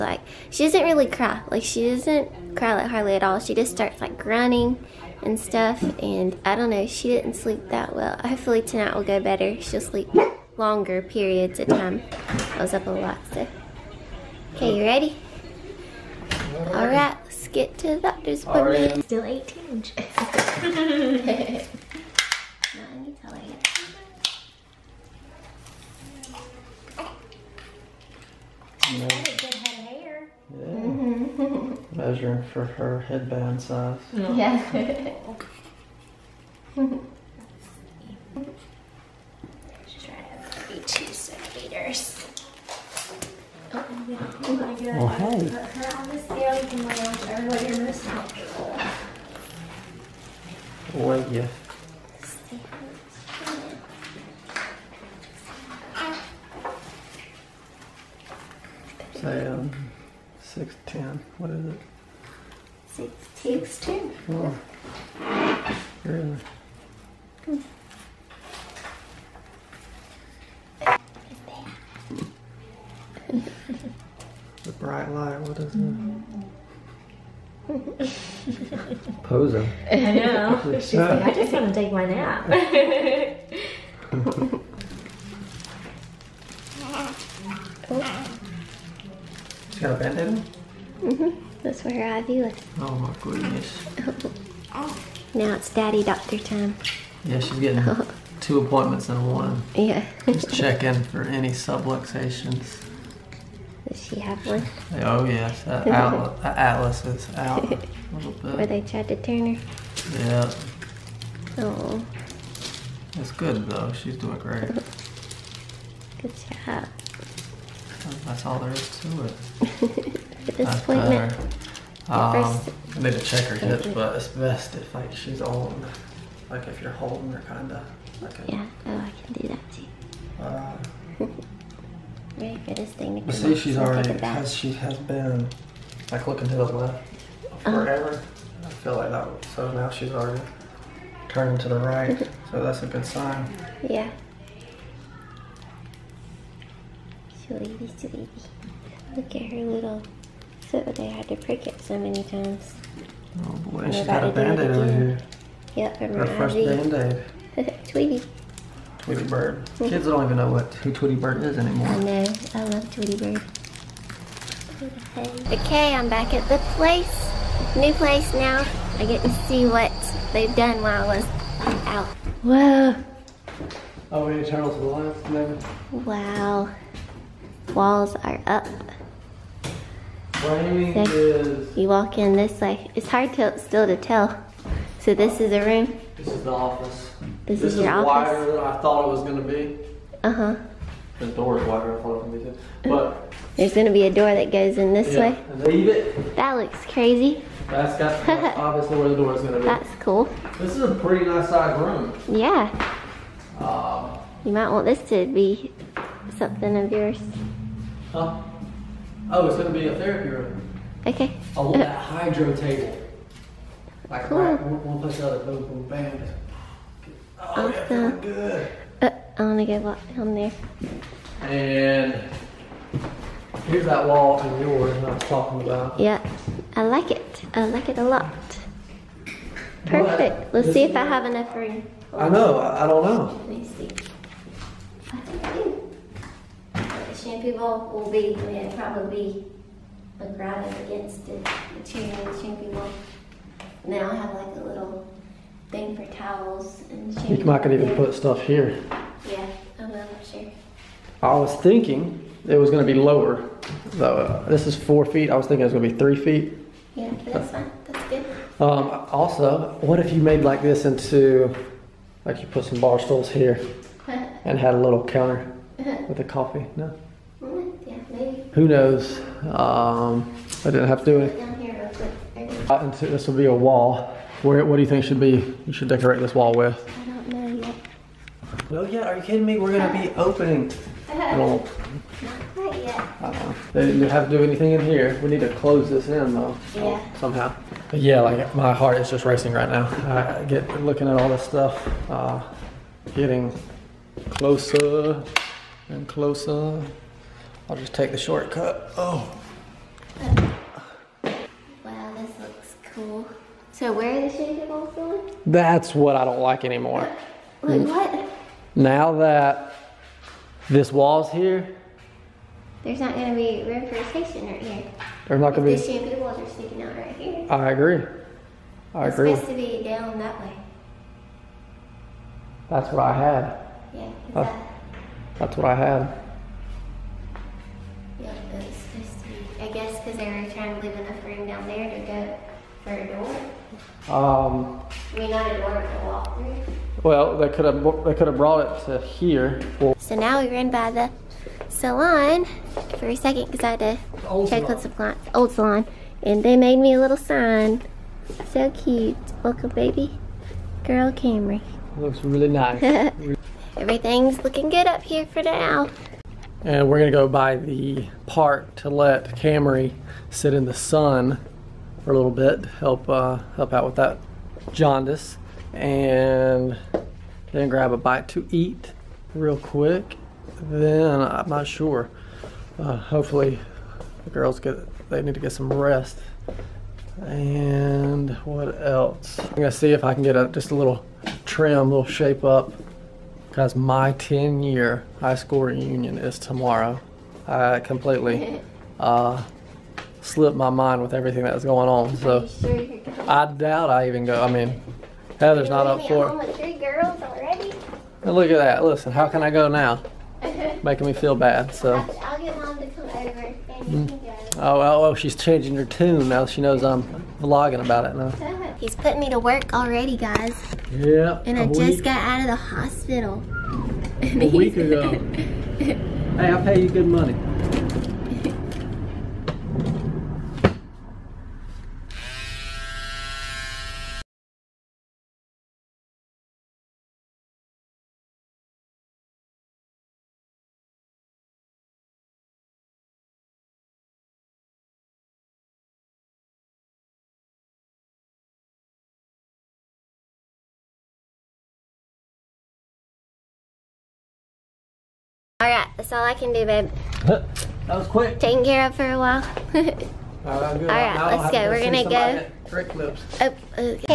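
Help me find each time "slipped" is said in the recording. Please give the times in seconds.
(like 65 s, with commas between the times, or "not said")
390 s.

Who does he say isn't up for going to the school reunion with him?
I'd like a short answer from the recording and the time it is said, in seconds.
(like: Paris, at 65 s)
Heather, at 395 s.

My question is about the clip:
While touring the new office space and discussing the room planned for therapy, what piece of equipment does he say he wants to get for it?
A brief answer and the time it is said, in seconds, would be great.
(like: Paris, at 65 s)
hydro table, at 211 s.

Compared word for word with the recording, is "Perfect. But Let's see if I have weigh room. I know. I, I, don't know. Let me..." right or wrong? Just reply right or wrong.
wrong.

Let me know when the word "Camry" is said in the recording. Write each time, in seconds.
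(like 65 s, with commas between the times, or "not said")
351 s, 359 s.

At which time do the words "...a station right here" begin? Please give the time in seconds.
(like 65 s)
313 s.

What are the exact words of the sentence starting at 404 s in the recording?
Oh, well, oh, oh, she's changing her tune now.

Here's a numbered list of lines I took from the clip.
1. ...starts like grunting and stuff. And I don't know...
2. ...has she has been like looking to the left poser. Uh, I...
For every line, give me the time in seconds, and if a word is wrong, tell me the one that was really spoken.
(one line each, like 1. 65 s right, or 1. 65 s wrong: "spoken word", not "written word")
1. 3 s right
2. 134 s wrong: "forever", not "poser".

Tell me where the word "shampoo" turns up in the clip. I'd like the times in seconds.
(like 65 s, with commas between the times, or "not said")
237 s, 242 s, 247 s, 316 s.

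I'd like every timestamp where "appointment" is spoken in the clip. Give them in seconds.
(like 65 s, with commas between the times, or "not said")
18 s, 98 s, 120 s.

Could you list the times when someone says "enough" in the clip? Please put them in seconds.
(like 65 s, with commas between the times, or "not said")
231 s, 330 s.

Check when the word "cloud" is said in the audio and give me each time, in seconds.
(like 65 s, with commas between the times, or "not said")
not said.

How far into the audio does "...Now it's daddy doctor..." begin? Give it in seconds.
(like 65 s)
95 s.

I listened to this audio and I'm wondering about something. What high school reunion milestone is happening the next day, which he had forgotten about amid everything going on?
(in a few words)
10 year.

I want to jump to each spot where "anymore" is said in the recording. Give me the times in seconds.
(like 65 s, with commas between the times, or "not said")
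161 s, 306 s.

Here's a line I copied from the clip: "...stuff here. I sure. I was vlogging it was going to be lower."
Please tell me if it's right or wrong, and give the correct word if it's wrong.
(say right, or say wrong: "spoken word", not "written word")
wrong: "thinking", not "vlogging".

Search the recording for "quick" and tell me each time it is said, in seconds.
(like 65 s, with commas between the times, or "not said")
272 s, 369 s, 448 s.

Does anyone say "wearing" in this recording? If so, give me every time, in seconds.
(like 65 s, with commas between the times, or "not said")
not said.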